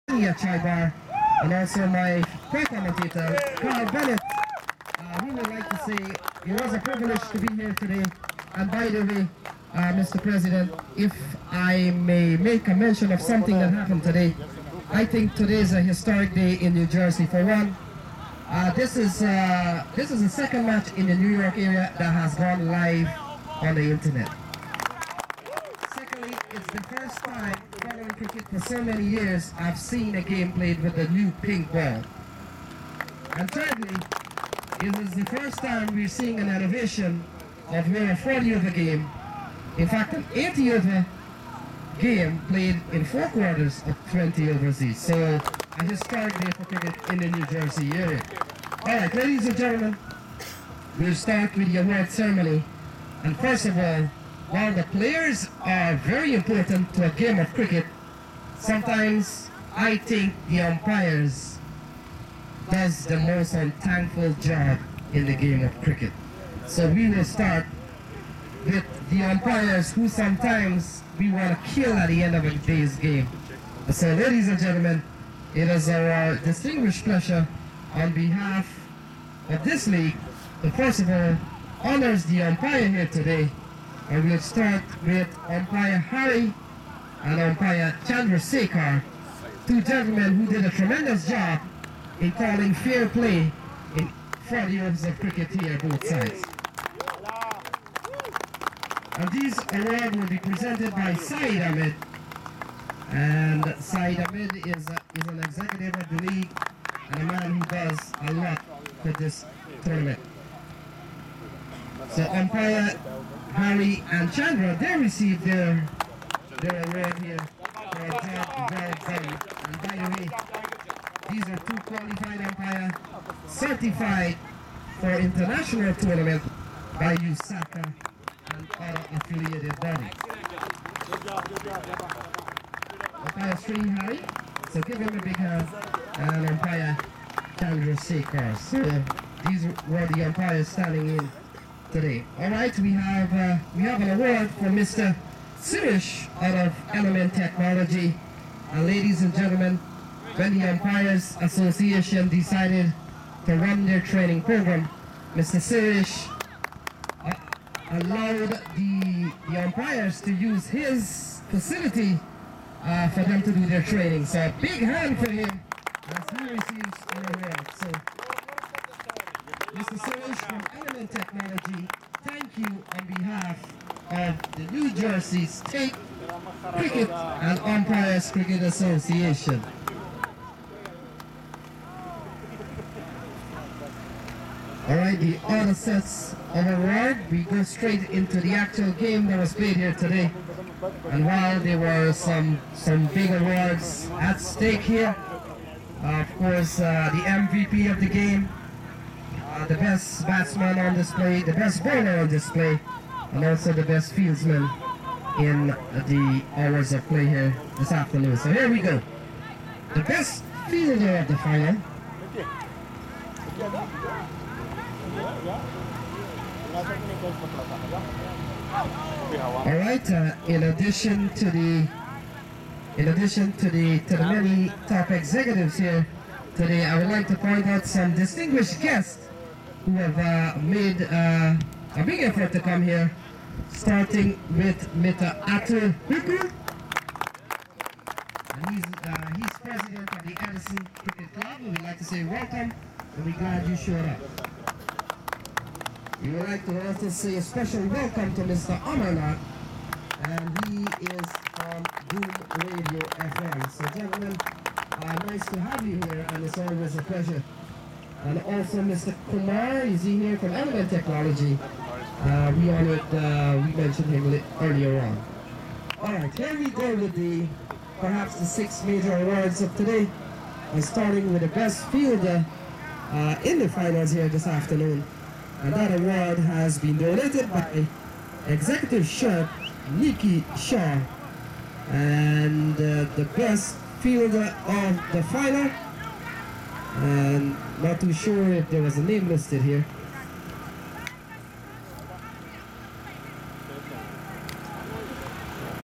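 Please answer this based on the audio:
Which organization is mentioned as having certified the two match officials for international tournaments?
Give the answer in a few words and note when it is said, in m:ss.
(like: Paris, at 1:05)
USACA, at 2:07.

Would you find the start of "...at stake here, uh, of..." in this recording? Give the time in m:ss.
3:14.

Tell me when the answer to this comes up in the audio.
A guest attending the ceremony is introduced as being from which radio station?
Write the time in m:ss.
4:12.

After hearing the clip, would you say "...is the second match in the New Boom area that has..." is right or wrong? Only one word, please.
wrong.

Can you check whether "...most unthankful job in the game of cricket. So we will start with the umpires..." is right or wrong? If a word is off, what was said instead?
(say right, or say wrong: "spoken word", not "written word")
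right.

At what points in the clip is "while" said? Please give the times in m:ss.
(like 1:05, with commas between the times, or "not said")
0:54, 3:11.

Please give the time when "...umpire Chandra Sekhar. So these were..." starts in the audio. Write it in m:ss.
2:16.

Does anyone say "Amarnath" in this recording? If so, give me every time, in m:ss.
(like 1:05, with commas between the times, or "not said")
4:08.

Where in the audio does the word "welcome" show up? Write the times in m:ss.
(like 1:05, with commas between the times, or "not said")
4:02, 4:07.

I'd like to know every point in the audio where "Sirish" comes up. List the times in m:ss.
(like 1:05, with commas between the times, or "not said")
2:25, 2:35.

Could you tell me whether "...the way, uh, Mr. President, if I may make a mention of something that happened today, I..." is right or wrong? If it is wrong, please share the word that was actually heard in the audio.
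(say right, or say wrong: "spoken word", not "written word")
right.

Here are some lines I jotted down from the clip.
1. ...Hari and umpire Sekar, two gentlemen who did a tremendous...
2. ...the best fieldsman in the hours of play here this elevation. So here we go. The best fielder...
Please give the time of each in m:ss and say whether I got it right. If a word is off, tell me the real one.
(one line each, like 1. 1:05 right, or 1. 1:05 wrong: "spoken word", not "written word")
1. 1:25 right
2. 3:23 wrong: "afternoon", not "elevation".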